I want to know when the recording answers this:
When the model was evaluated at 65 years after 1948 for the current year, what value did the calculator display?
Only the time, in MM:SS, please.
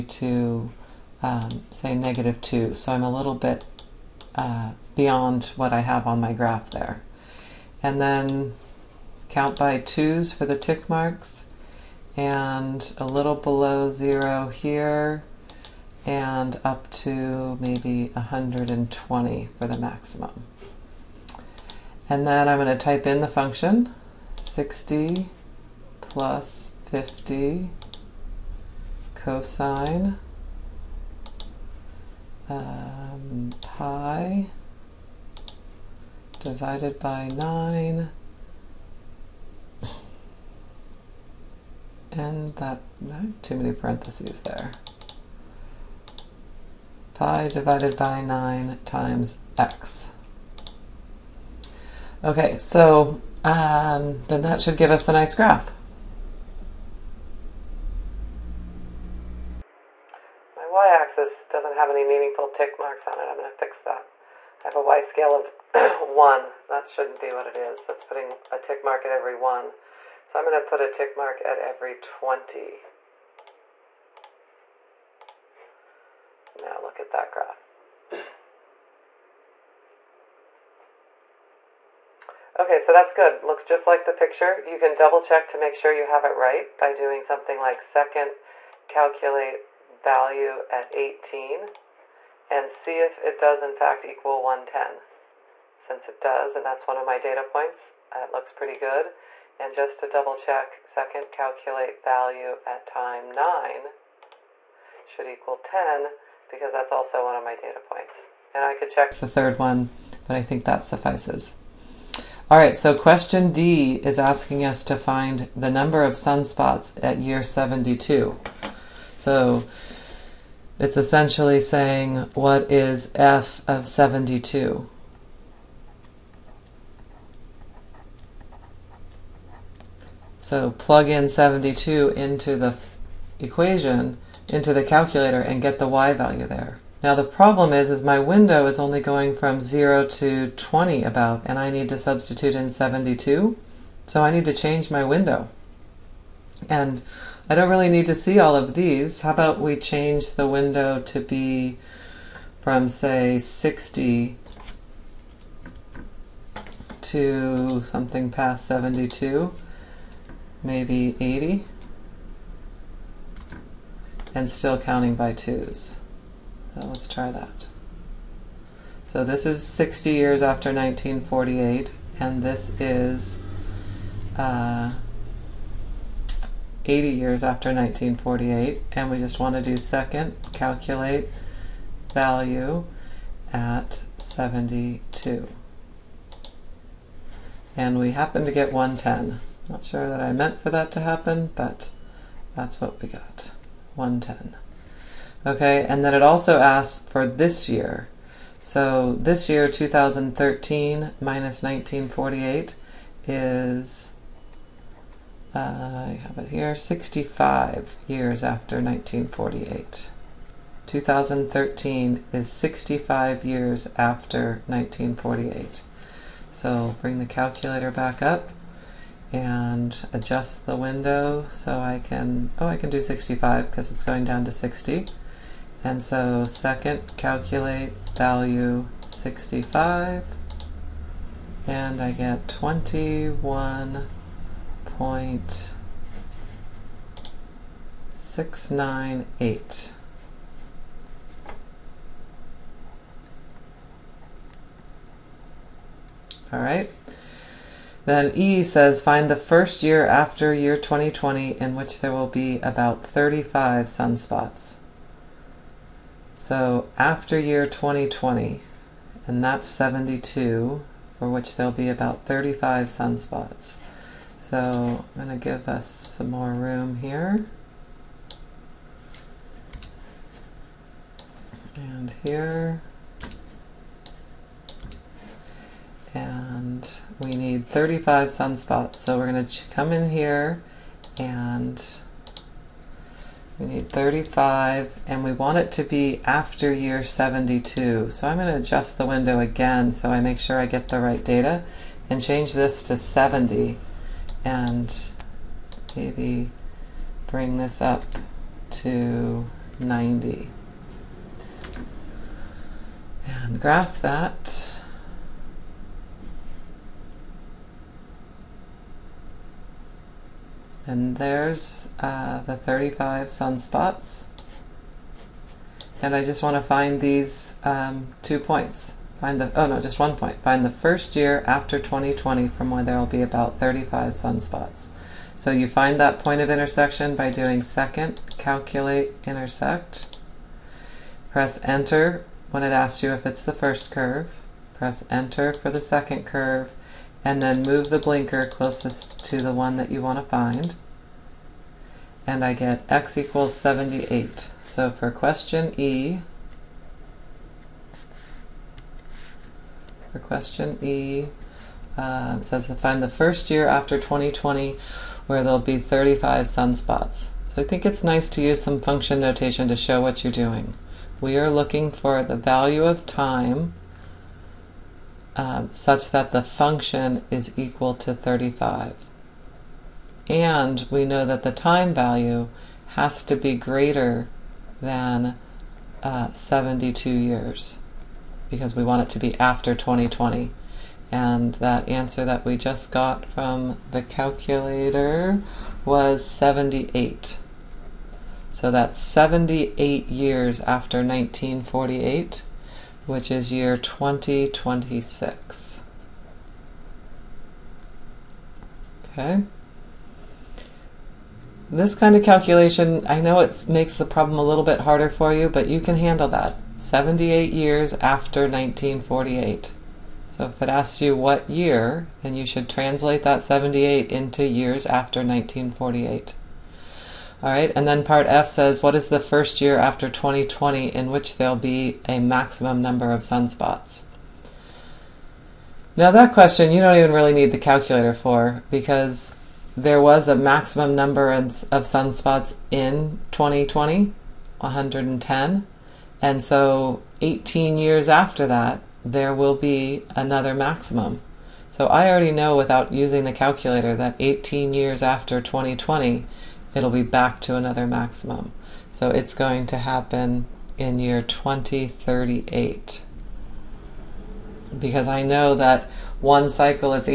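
03:52.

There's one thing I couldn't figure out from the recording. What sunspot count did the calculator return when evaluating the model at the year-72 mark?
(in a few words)
110.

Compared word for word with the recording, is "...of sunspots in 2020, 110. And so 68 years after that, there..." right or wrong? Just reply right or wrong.
wrong.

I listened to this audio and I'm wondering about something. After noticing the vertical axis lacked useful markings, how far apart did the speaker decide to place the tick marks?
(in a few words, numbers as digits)
20.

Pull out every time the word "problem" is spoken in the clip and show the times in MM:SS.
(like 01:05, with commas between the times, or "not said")
02:17, 06:44.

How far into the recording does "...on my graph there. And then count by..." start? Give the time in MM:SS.
00:06.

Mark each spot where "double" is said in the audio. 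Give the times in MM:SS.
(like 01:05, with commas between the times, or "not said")
01:24, 01:40.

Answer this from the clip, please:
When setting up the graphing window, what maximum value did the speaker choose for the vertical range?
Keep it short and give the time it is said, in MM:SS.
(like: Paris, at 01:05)
120, at 00:18.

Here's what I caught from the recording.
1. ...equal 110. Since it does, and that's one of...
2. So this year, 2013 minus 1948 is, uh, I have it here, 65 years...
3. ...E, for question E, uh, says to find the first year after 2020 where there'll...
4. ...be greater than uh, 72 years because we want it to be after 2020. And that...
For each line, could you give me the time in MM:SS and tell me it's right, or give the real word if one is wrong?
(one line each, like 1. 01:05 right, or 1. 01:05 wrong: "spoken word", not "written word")
1. 01:34 right
2. 03:18 right
3. 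05:45 right
4. 06:13 right.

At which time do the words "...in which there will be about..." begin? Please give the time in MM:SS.
04:11.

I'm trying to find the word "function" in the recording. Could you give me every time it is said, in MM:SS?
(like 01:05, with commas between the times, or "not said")
00:23, 05:58, 06:06.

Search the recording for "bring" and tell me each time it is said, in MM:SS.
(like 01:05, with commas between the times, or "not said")
03:37, 04:57.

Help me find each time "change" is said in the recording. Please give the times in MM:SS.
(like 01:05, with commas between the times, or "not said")
02:24, 02:29, 04:52.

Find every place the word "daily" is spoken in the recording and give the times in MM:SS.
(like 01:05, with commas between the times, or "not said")
not said.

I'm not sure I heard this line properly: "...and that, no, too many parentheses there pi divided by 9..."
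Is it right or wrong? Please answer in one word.
right.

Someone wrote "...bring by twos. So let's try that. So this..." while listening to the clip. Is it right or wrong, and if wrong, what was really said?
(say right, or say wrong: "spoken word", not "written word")
wrong: "counting", not "bring".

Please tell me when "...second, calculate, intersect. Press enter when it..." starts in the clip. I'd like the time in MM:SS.
05:27.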